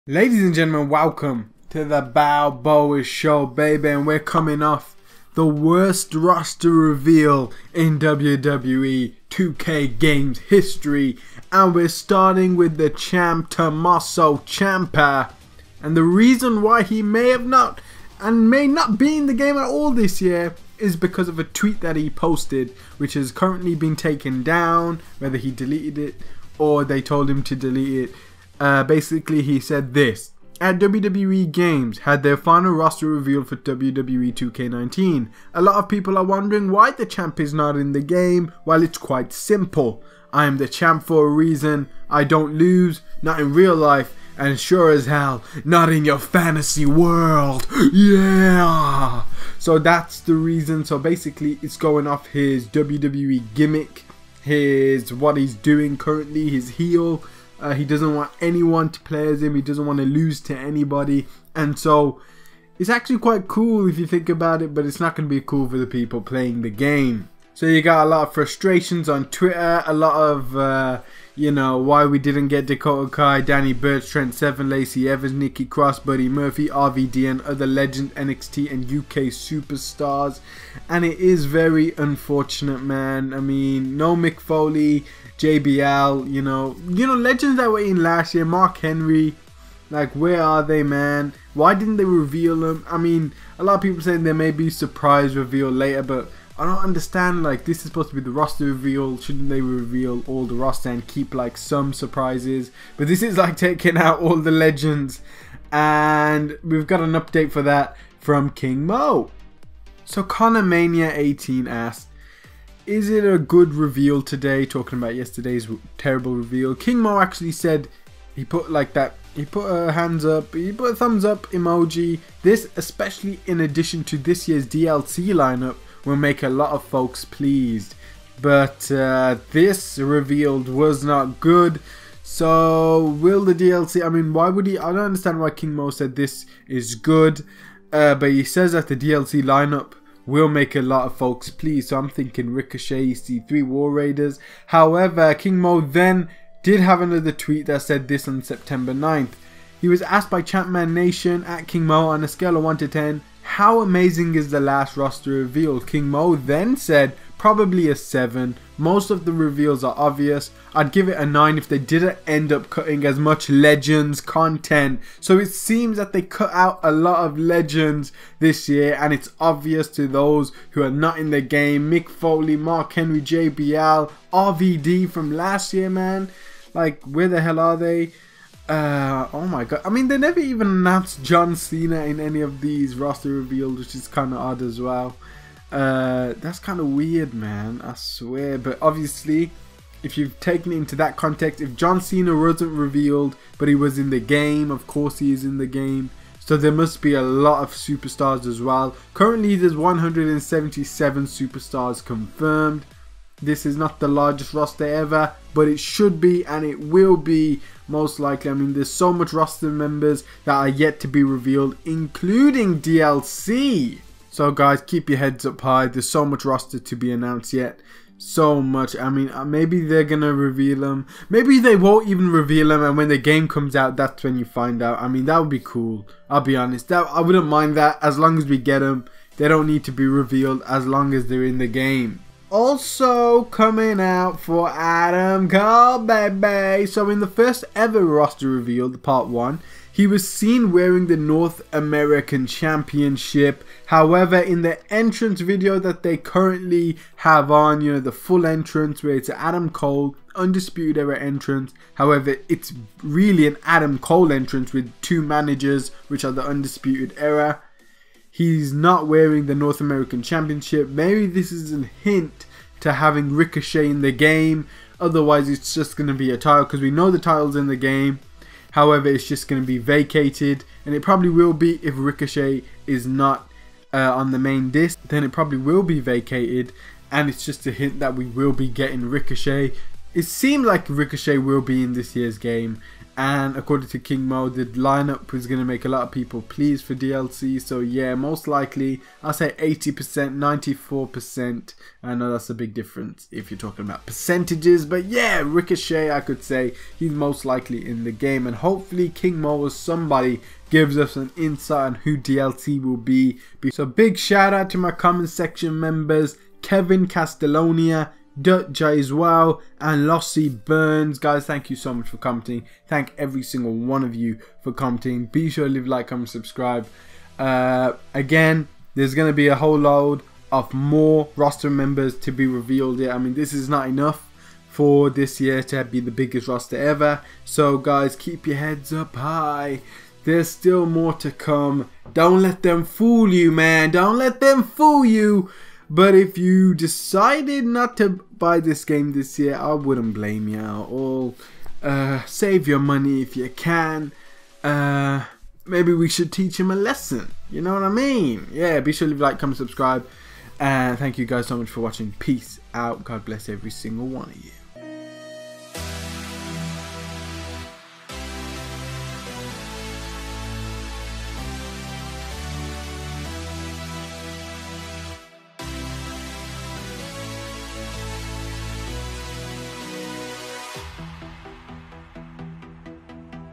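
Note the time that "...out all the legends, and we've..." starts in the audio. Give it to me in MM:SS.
01:43.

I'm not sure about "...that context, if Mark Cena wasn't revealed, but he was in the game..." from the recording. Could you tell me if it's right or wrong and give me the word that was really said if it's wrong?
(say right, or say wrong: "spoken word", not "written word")
wrong: "John", not "Mark".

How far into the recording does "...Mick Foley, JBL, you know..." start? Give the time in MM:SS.
01:24.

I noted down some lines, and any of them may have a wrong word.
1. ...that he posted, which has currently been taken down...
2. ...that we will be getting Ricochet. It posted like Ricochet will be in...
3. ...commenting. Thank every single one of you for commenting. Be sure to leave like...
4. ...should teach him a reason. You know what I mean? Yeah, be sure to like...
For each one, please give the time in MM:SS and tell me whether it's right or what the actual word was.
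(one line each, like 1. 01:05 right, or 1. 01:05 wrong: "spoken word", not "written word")
1. 00:21 right
2. 04:37 wrong: "seemed", not "posted"
3. 05:12 right
4. 05:46 wrong: "lesson", not "reason".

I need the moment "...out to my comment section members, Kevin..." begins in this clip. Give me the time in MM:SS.
05:04.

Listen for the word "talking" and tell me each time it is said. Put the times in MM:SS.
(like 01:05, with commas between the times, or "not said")
01:54, 04:53.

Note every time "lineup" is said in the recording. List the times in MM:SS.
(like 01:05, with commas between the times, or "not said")
02:05, 02:19, 04:44.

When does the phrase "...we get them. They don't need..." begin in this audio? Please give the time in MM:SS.
03:48.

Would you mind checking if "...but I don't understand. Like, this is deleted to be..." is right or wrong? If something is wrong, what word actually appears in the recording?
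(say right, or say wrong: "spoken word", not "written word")
wrong: "supposed", not "deleted".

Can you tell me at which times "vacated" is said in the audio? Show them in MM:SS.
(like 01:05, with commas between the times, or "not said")
04:29, 04:35.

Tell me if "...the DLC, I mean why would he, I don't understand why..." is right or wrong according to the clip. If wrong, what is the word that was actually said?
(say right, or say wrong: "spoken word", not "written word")
right.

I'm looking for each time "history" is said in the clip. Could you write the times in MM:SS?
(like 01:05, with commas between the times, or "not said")
00:10.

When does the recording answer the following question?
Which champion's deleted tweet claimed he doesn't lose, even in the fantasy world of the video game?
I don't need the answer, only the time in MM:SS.
00:13.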